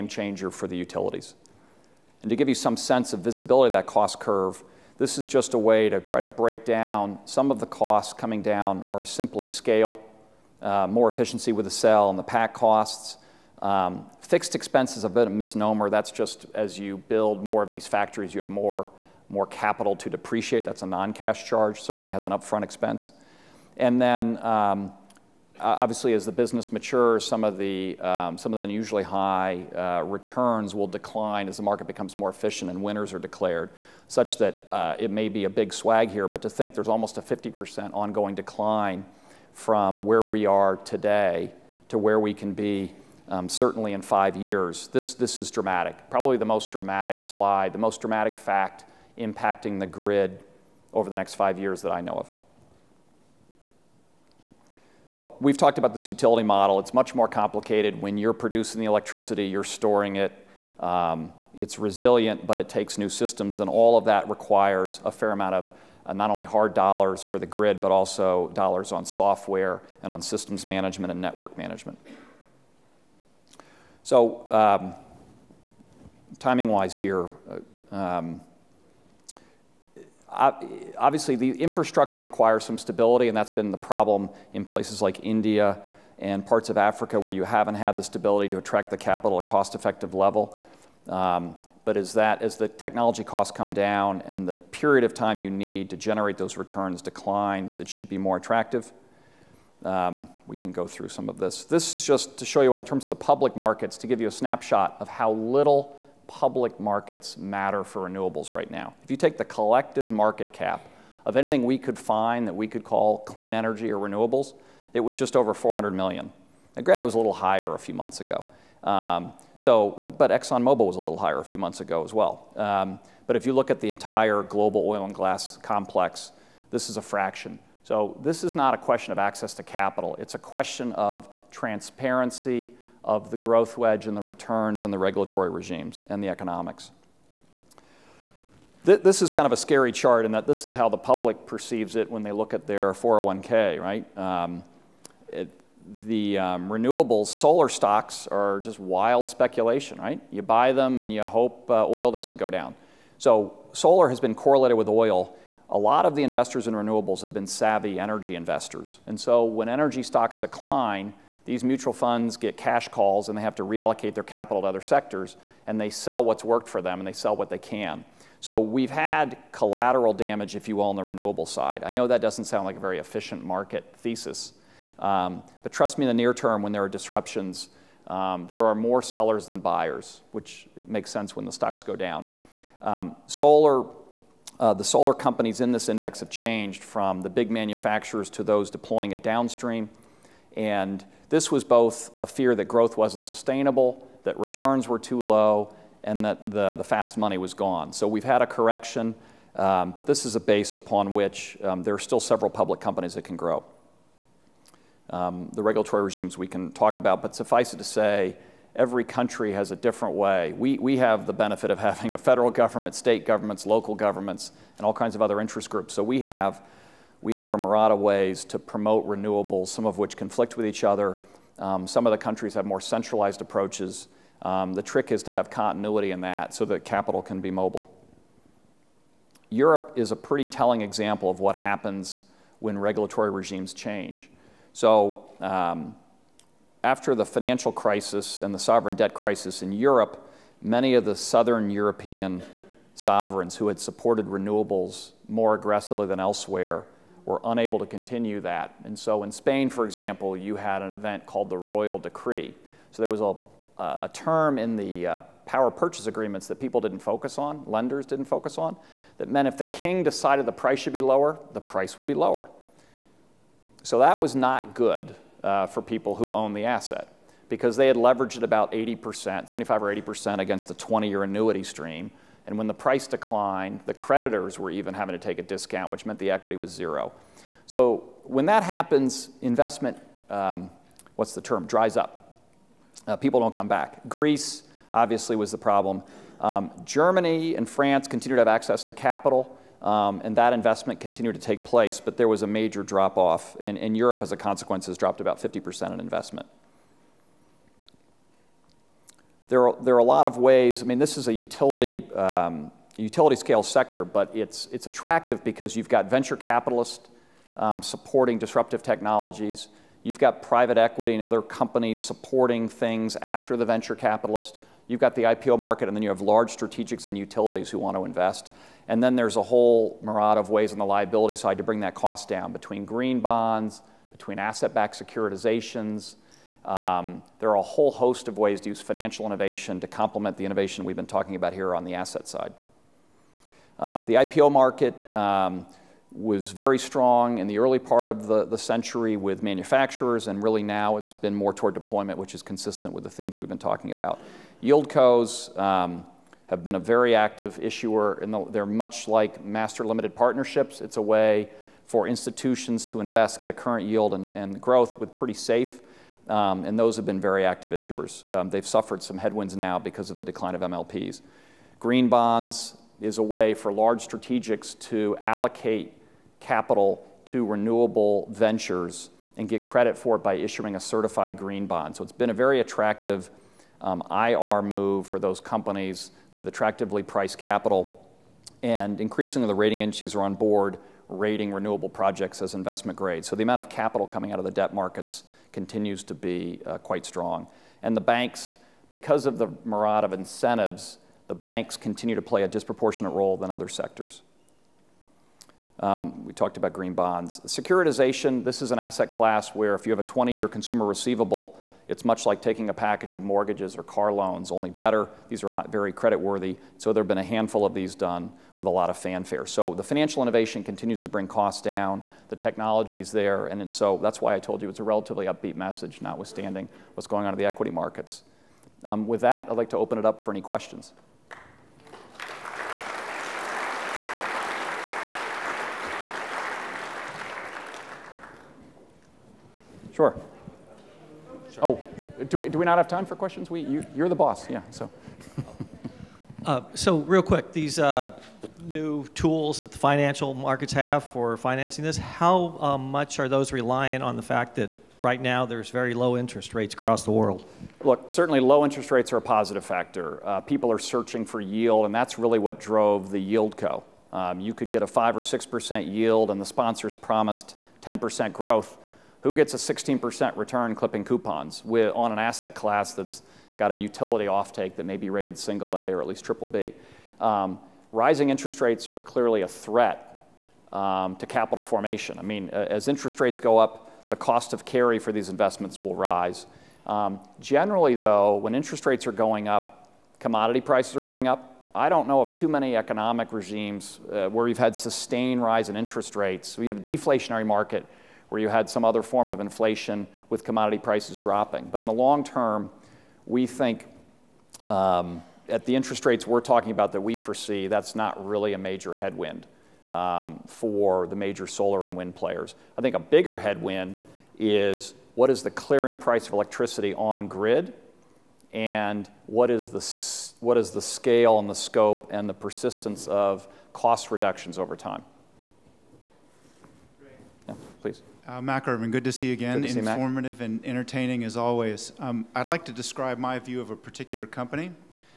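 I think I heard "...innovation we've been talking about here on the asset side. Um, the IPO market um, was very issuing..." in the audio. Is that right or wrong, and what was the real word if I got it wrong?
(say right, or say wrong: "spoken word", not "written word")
wrong: "strong", not "issuing".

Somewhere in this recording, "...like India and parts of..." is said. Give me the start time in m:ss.
1:25.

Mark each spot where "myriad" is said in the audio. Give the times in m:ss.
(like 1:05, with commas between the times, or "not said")
3:37, 5:20, 6:29.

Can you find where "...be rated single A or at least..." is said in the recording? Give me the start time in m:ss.
7:44.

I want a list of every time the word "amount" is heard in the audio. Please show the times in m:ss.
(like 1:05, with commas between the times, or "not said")
1:05, 6:23.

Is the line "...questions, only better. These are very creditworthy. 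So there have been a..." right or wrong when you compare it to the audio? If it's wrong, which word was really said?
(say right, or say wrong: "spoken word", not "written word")
wrong: "loans", not "questions".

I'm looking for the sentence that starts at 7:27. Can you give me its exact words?
Look, certainly low interest rates are a positive factor.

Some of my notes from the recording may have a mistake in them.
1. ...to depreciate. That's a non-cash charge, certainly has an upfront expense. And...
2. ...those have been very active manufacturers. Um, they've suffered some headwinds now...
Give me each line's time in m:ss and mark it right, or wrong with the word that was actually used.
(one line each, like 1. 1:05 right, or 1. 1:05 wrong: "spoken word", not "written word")
1. 0:19 right
2. 5:56 wrong: "issuers", not "manufacturers".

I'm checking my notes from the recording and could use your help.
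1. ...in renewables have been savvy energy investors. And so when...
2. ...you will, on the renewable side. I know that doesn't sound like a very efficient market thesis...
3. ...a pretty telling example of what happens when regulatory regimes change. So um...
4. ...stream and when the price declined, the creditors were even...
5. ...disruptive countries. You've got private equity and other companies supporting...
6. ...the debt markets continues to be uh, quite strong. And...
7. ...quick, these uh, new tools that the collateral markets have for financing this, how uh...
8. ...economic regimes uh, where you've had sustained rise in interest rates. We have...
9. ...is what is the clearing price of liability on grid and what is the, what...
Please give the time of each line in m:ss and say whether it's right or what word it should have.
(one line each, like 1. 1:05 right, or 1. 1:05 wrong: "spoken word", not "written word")
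1. 2:36 right
2. 2:50 right
3. 3:50 right
4. 4:31 right
5. 5:08 wrong: "technologies", not "countries"
6. 6:24 right
7. 7:17 wrong: "financial", not "collateral"
8. 8:02 right
9. 8:24 wrong: "electricity", not "liability".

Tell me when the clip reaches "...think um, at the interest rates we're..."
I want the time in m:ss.
8:13.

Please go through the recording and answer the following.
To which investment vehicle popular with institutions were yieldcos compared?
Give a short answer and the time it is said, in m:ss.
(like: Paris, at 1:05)
master limited partnerships, at 5:49.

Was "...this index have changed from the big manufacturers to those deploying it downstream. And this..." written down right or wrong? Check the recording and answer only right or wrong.
right.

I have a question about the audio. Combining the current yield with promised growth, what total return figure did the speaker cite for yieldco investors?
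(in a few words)
16%.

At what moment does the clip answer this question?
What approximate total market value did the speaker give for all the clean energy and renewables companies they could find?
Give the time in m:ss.
1:55.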